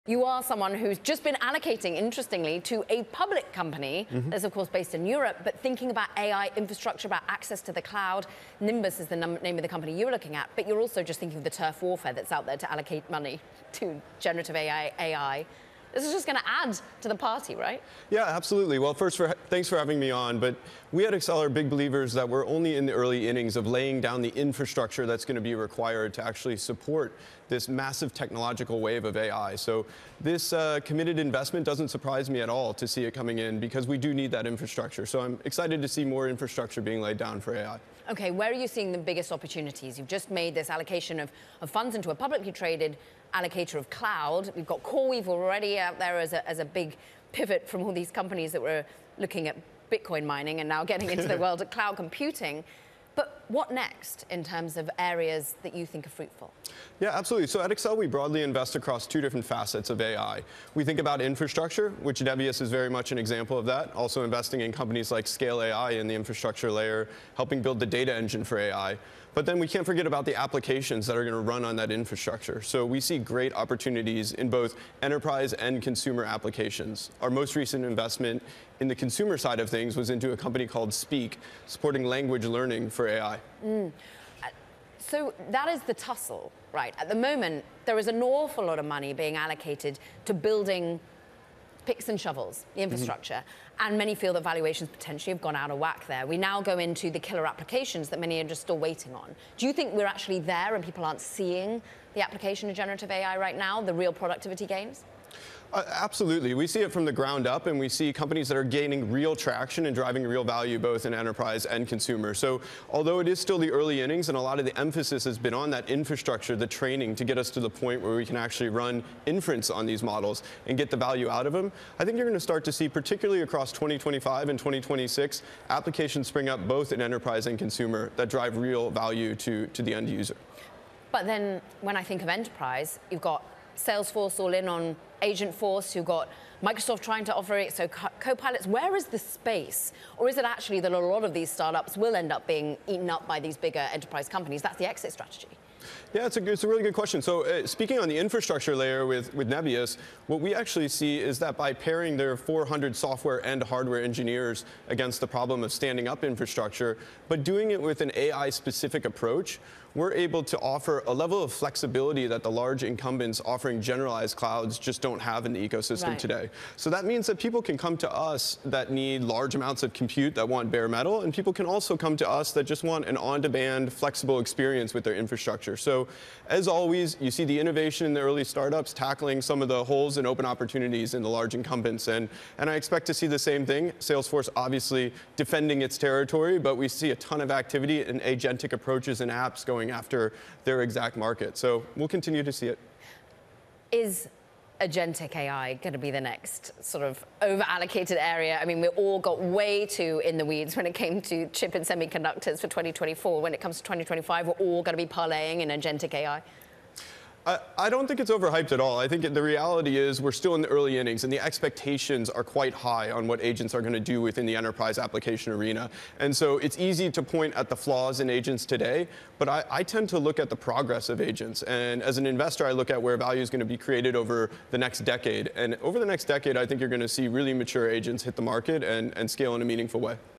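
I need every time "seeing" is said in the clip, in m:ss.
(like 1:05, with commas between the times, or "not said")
0:38, 1:41.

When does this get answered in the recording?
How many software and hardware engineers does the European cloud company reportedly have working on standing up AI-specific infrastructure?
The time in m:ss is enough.
2:32.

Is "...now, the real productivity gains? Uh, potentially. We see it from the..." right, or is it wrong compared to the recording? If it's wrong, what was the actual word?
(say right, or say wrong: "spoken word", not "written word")
wrong: "absolutely", not "potentially".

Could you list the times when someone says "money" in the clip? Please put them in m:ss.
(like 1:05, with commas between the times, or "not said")
0:13, 1:28.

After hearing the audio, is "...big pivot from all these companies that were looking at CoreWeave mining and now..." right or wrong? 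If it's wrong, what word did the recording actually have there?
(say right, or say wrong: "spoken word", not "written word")
wrong: "Bitcoin", not "CoreWeave".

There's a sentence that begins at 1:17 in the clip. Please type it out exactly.
Our most recent investment in the consumer side of things was into a company called Speak, supporting language learning for AI.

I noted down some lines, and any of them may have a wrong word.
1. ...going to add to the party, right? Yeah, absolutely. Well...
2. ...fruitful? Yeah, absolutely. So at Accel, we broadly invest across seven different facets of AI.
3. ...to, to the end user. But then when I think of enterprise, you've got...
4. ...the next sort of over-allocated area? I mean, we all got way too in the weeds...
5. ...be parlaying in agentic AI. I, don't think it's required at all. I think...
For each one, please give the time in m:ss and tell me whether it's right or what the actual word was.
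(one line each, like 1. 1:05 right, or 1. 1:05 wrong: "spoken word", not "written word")
1. 0:16 right
2. 0:56 wrong: "two", not "seven"
3. 2:09 right
4. 3:16 right
5. 3:25 wrong: "overhyped", not "required".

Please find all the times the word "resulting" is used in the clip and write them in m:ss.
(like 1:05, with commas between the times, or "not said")
not said.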